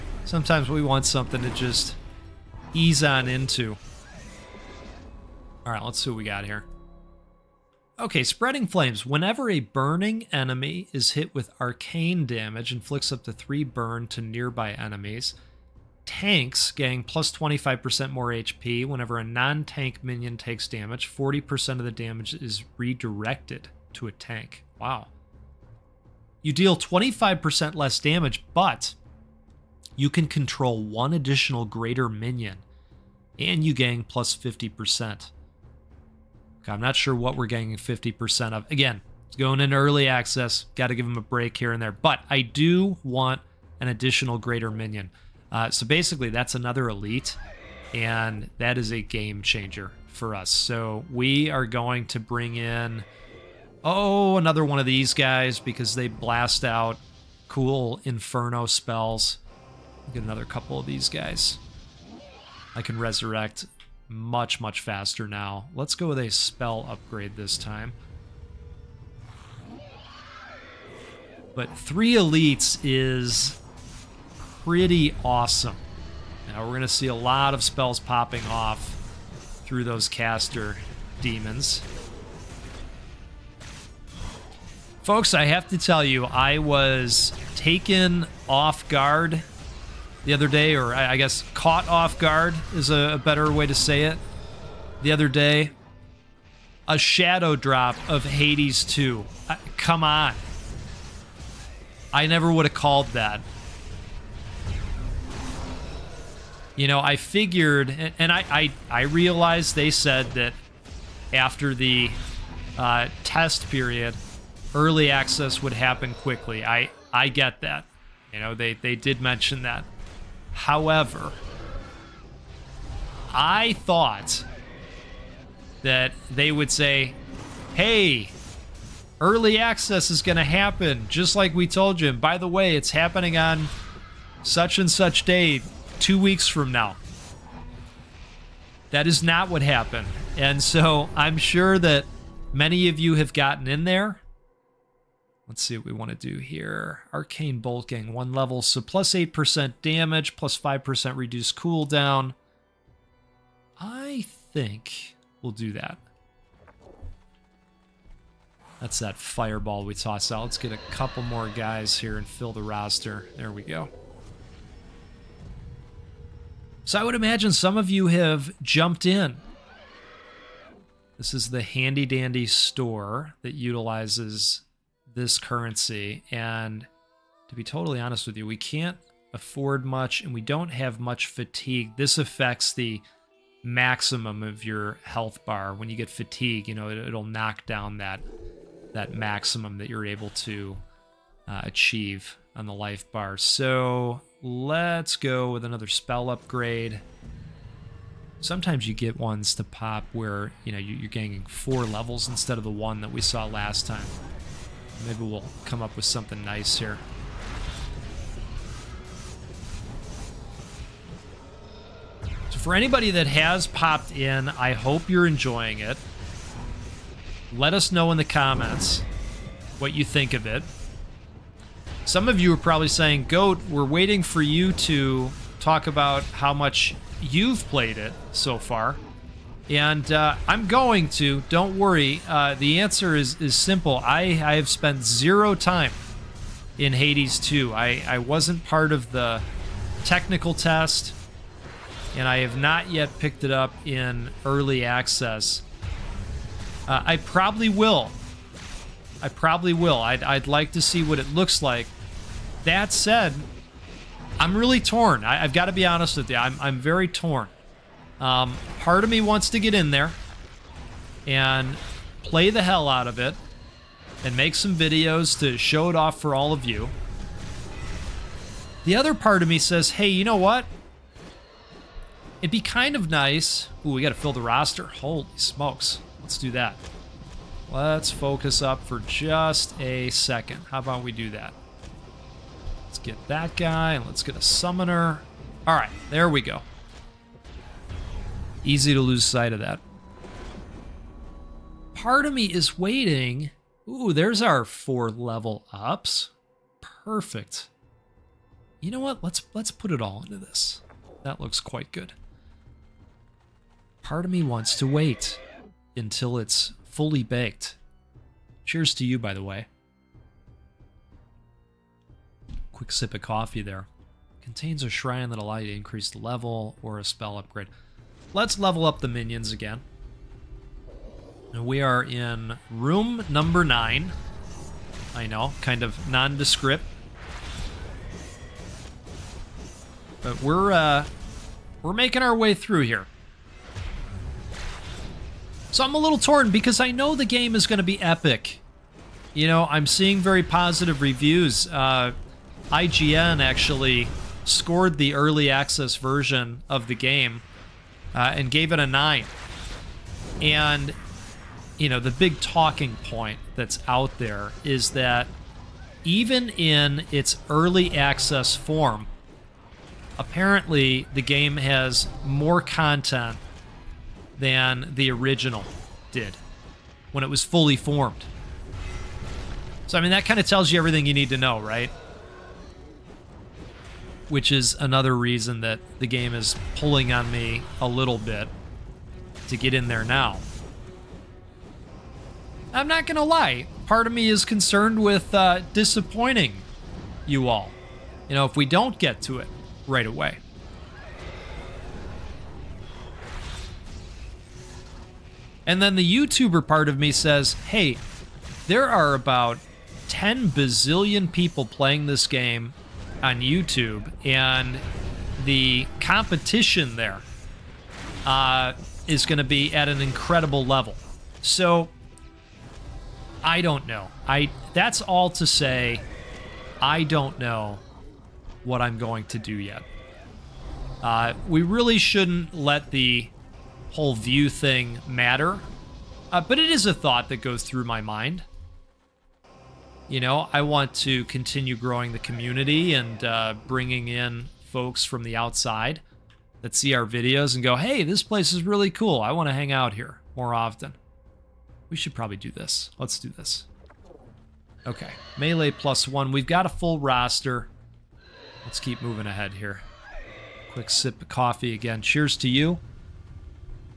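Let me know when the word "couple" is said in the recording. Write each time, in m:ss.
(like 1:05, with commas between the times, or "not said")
1:00, 2:40.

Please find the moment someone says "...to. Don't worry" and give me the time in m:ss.
3:51.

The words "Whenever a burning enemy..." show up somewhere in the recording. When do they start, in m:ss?
0:09.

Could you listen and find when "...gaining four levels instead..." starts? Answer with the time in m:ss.
3:21.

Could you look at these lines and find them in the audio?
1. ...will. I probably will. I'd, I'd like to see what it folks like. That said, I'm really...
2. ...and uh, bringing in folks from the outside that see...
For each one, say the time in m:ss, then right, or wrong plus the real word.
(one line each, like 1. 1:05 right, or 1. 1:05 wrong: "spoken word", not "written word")
1. 4:07 wrong: "looks", not "folks"
2. 7:12 right.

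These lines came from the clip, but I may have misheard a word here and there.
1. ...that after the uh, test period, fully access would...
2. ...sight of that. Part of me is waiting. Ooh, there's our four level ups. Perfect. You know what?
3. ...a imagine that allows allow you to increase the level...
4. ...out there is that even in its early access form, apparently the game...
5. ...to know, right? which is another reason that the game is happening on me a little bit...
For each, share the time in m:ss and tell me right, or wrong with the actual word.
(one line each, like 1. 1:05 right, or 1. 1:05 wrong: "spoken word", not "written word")
1. 1:50 wrong: "early", not "fully"
2. 4:49 right
3. 5:14 wrong: "shrine", not "imagine"
4. 5:53 right
5. 6:11 wrong: "pulling", not "happening".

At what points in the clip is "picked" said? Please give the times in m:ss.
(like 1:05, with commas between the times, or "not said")
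4:03.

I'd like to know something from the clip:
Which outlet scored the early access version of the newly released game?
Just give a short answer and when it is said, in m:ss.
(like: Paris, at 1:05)
IGN, at 5:42.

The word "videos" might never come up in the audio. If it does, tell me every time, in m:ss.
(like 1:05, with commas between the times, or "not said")
4:24, 7:17.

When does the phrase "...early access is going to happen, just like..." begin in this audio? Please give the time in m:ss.
2:09.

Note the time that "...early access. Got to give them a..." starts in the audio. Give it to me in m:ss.
0:39.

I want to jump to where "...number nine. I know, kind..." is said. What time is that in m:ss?
5:23.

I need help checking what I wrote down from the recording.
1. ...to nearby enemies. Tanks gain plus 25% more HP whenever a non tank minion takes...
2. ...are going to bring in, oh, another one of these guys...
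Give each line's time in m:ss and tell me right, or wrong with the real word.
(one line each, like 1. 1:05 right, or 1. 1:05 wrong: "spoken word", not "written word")
1. 0:14 right
2. 0:51 right.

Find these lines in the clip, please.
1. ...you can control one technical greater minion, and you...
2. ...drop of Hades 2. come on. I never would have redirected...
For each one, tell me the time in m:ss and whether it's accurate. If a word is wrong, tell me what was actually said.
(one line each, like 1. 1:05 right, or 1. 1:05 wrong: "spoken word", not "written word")
1. 0:29 wrong: "additional", not "technical"
2. 1:37 wrong: "called", not "redirected".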